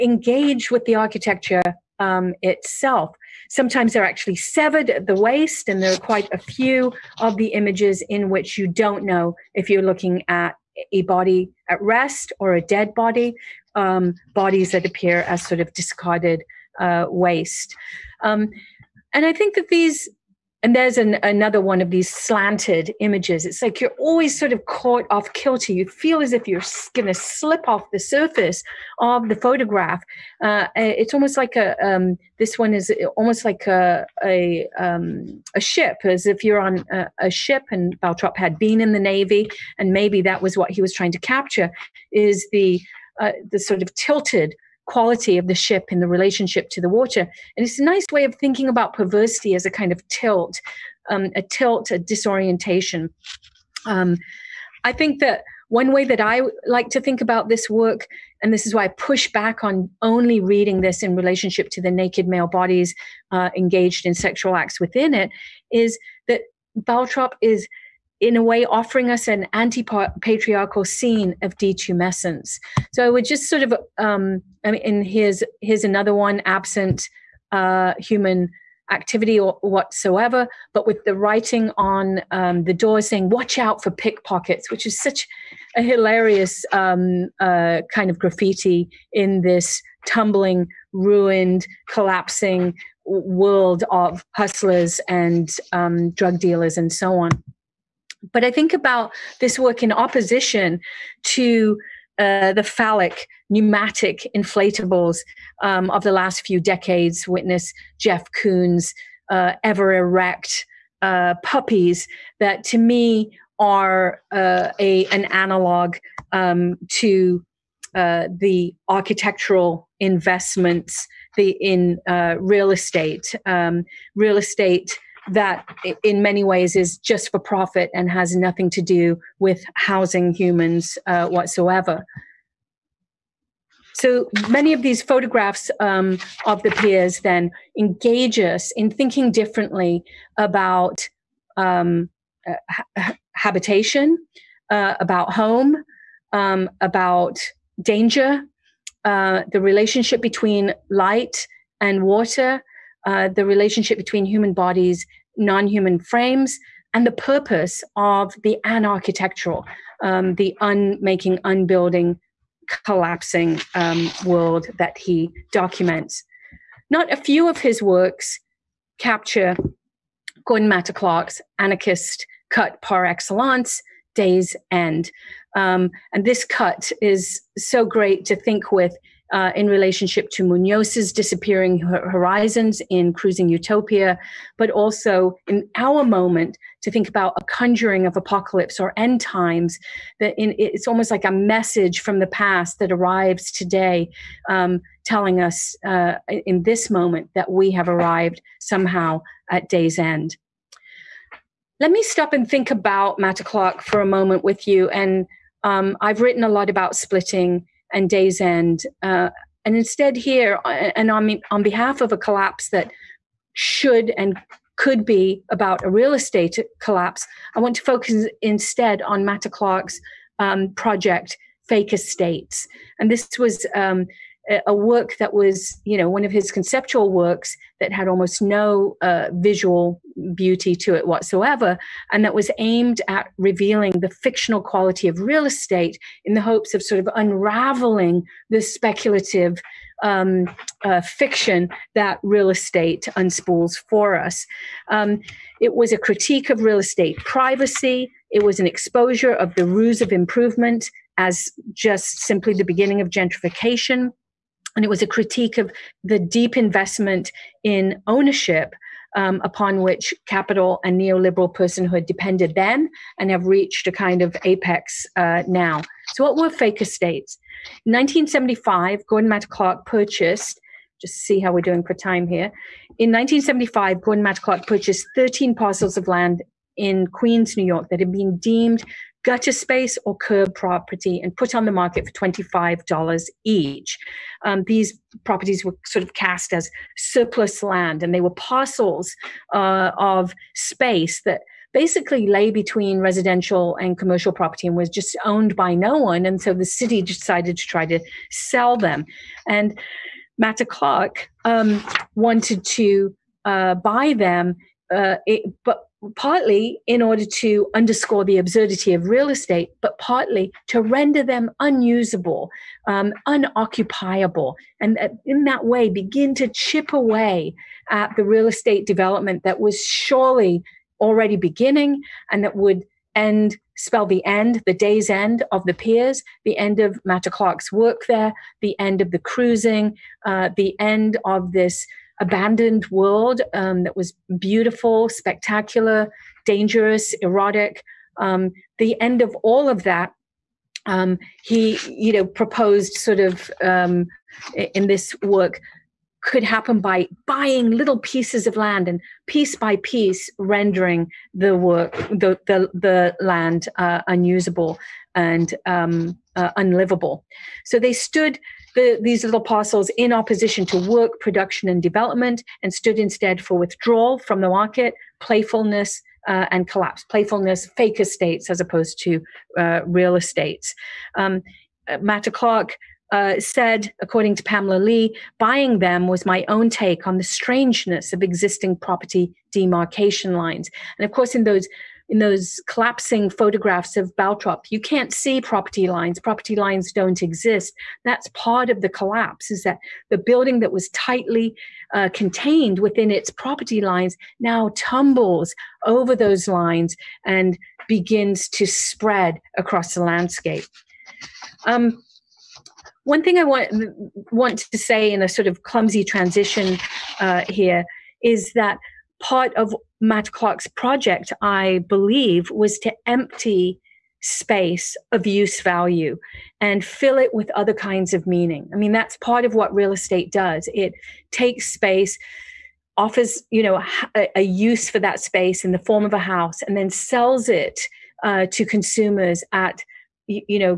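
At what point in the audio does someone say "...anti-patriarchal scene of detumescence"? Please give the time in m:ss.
1:09.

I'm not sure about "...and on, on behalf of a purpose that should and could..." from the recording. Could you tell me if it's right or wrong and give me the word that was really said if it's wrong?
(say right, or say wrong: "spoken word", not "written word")
wrong: "collapse", not "purpose".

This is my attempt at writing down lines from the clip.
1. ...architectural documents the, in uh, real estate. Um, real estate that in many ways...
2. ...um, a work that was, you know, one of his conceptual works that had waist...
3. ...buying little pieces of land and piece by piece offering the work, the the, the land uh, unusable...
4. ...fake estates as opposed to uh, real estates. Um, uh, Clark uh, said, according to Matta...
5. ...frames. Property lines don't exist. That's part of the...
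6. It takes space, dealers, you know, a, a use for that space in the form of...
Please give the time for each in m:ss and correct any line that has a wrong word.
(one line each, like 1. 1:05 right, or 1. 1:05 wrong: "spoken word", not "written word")
1. 1:58 wrong: "investments", not "documents"
2. 3:43 wrong: "almost", not "waist"
3. 5:47 wrong: "rendering", not "offering"
4. 6:07 wrong: "Pamela", not "Matta"
5. 6:25 wrong: "lines", not "frames"
6. 7:00 wrong: "offers", not "dealers".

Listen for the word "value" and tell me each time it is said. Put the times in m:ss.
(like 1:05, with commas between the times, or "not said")
6:55.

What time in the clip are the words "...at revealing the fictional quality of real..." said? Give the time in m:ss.
3:53.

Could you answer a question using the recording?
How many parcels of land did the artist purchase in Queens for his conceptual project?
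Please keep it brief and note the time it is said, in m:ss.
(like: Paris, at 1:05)
13, at 4:35.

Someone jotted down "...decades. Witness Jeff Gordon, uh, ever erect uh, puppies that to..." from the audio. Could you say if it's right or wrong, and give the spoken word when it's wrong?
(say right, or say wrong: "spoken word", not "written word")
wrong: "Koons", not "Gordon".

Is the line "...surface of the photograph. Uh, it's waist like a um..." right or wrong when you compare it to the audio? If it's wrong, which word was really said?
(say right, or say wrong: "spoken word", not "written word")
wrong: "almost", not "waist".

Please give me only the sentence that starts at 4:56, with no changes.
And so the city decided to try to sell them.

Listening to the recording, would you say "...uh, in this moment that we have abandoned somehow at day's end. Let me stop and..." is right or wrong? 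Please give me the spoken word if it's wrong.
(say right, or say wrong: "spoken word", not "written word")
wrong: "arrived", not "abandoned".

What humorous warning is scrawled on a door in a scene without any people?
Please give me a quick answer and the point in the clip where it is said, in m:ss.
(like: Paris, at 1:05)
Watch out for pickpockets, at 1:23.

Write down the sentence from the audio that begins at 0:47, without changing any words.
And it's a nice way of thinking about perversity as a kind of tilt, um, a tilt, a disorientation.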